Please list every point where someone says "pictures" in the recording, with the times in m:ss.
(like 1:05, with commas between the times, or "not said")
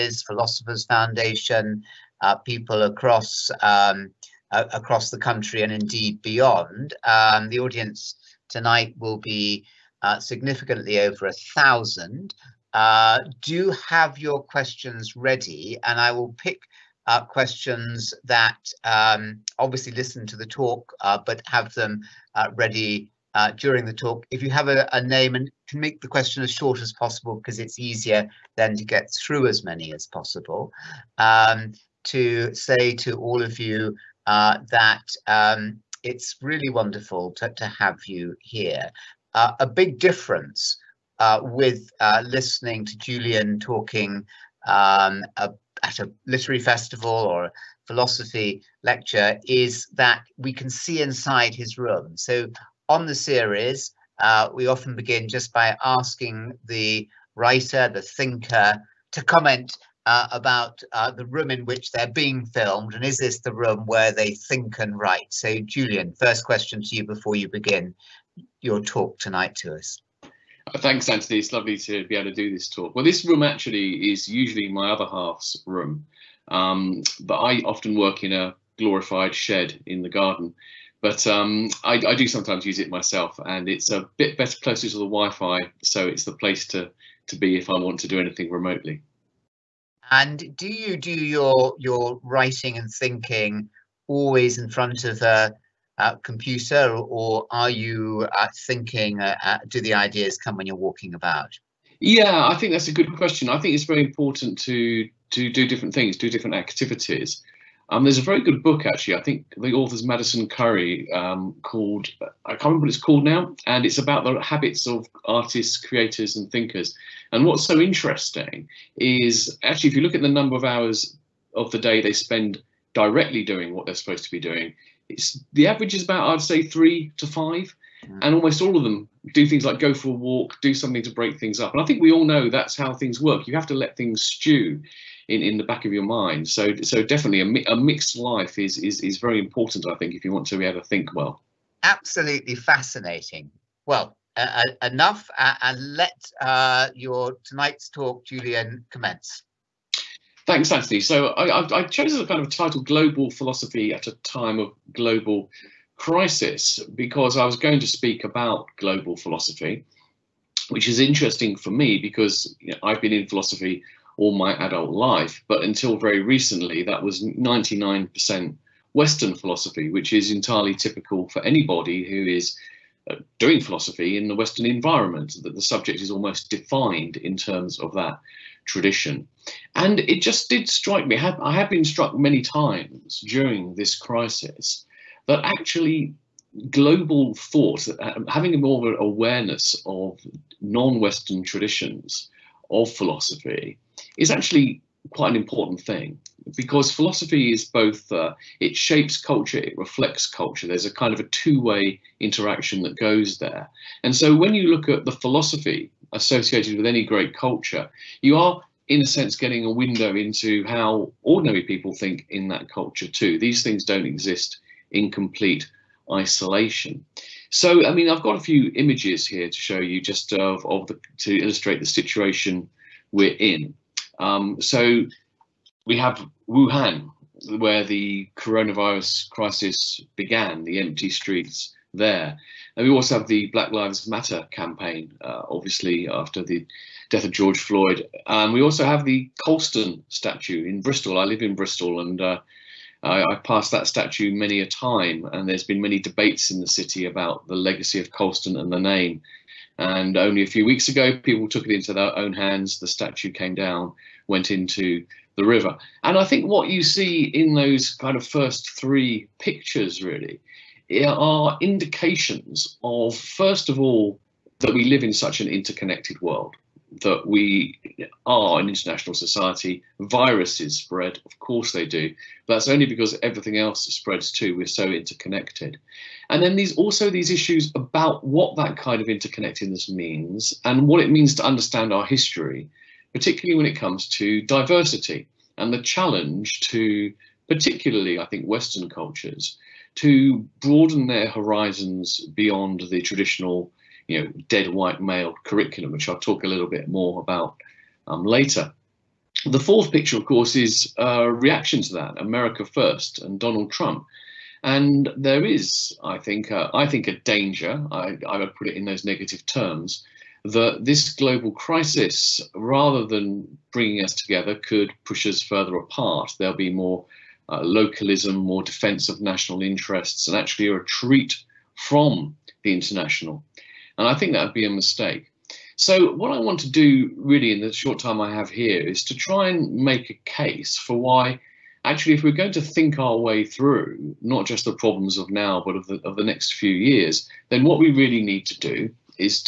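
4:19, 4:59.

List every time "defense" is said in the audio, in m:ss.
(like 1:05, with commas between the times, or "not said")
5:18.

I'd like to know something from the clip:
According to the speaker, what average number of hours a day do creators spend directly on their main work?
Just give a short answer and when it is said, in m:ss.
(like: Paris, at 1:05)
3 to 5, at 2:06.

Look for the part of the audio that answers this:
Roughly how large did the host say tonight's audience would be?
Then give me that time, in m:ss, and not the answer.
0:10.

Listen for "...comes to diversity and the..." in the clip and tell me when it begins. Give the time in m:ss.
4:43.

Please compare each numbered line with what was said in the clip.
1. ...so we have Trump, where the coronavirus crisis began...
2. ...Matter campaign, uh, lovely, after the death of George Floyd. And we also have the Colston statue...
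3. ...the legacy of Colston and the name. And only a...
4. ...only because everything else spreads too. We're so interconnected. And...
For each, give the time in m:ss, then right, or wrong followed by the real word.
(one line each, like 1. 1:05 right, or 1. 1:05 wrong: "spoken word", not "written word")
1. 3:44 wrong: "Wuhan", not "Trump"
2. 3:54 wrong: "obviously", not "lovely"
3. 4:07 right
4. 4:32 right.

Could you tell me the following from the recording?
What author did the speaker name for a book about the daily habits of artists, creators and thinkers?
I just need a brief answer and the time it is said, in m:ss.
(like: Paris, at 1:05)
Madison Currey, at 1:50.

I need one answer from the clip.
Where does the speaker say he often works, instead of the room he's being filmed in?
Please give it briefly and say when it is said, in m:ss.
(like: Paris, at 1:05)
a glorified shed in the garden, at 1:18.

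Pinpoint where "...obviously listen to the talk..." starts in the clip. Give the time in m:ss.
0:19.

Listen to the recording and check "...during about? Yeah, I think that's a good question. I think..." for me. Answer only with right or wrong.
wrong.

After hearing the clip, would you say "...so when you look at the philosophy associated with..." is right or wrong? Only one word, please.
right.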